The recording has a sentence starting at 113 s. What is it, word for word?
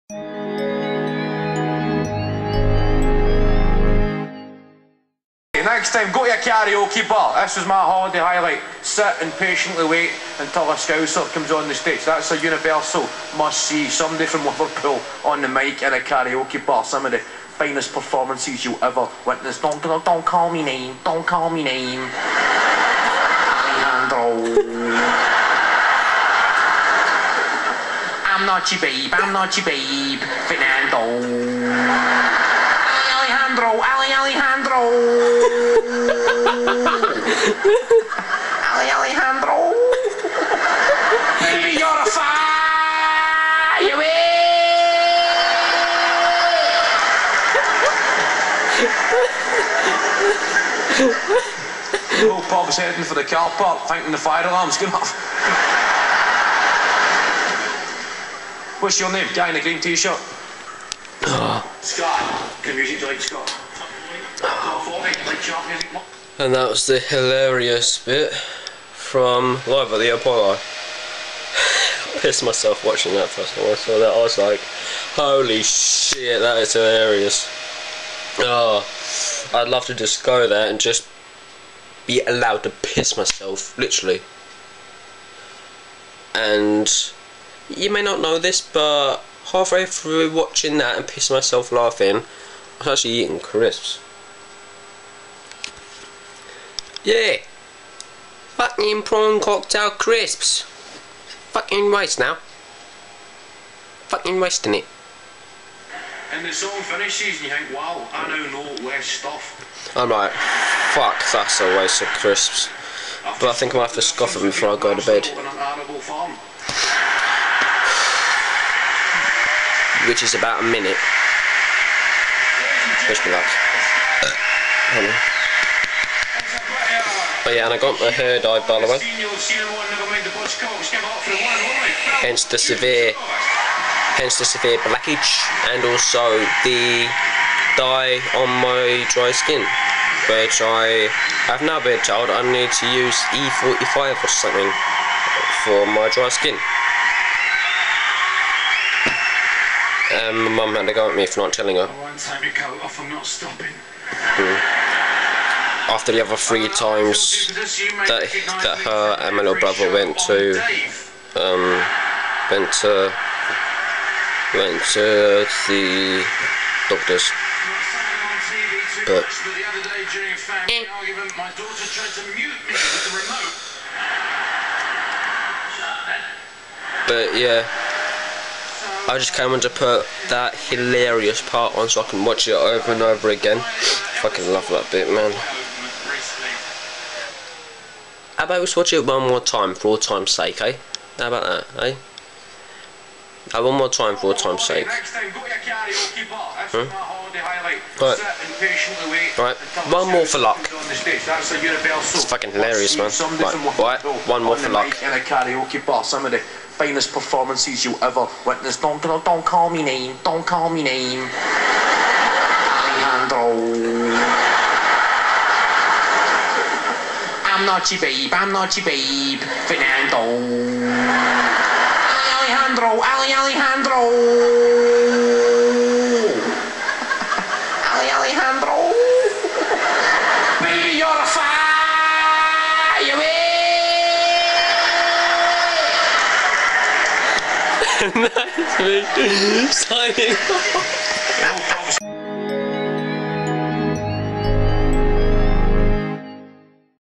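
but I think I to have to scoff it them before I go to bed.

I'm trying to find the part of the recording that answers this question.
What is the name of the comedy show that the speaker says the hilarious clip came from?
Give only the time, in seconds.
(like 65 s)
69 s.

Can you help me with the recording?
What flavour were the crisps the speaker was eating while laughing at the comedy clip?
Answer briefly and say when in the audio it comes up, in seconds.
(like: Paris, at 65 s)
Prawn cocktail, at 99 s.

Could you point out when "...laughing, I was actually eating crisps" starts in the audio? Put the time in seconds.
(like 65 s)
91 s.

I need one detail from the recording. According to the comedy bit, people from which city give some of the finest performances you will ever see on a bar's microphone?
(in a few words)
Liverpool.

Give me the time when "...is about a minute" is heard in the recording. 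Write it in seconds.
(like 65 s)
120 s.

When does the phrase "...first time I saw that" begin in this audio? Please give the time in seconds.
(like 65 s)
73 s.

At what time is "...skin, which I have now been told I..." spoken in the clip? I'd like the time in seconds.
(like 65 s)
139 s.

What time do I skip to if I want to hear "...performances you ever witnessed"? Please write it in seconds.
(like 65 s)
207 s.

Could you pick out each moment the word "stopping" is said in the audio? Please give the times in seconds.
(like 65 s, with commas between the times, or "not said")
153 s.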